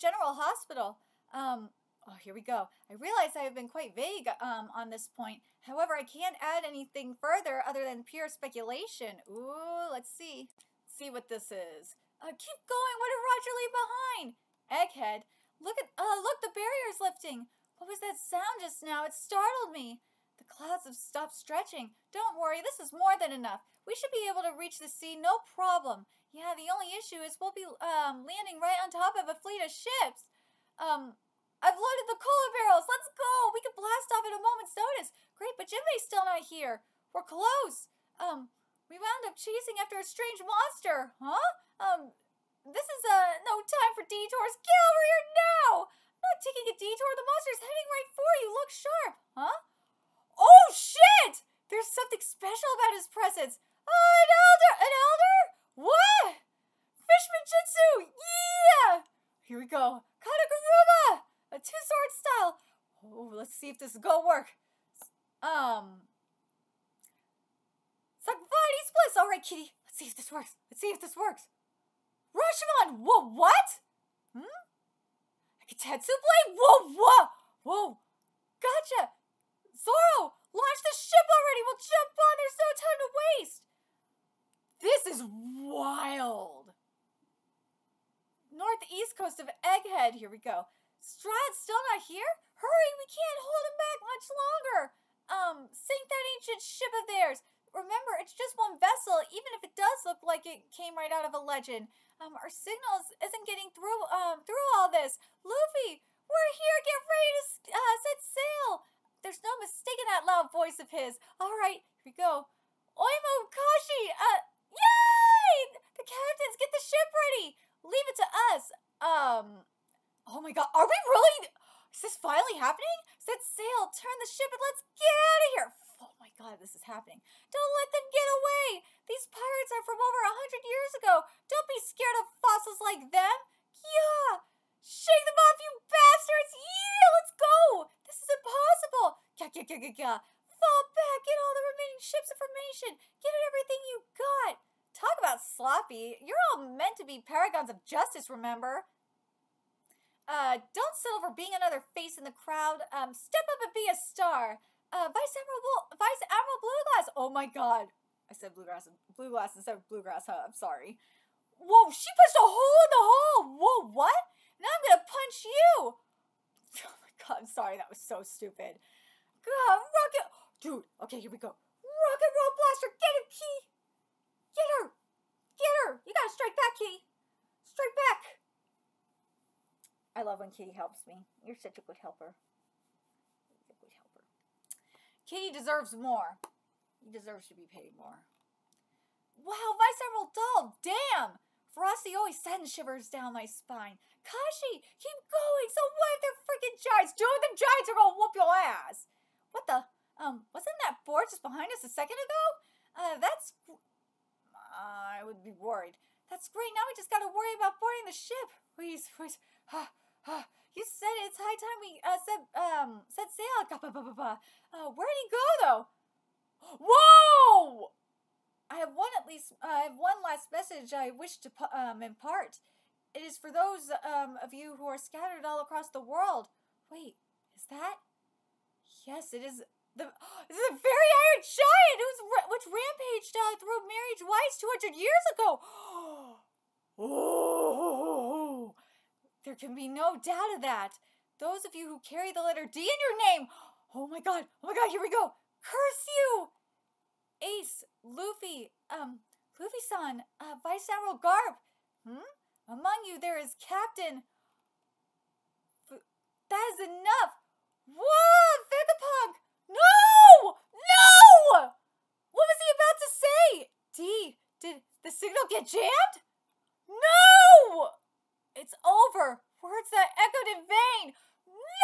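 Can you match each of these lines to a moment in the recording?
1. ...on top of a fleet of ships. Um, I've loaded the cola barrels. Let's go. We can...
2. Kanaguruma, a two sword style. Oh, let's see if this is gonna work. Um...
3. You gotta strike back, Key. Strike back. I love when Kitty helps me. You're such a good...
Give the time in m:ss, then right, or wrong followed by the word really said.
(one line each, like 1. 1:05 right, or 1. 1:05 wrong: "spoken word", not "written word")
1. 0:28 right
2. 1:00 right
3. 2:56 right.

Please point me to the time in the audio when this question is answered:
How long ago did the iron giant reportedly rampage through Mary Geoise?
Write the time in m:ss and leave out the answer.
3:54.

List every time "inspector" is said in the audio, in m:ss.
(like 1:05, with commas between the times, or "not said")
not said.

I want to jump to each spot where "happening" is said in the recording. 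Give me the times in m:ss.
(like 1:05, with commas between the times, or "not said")
2:02, 2:06.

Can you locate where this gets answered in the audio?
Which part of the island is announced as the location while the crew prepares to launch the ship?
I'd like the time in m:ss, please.
1:28.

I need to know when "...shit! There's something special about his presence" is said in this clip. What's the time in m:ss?
0:50.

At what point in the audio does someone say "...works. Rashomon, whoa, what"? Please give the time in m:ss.
1:11.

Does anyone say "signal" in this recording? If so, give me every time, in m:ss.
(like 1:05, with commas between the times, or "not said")
1:42, 4:25.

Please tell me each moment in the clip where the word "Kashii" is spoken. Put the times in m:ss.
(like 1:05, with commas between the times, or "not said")
1:53, 3:14.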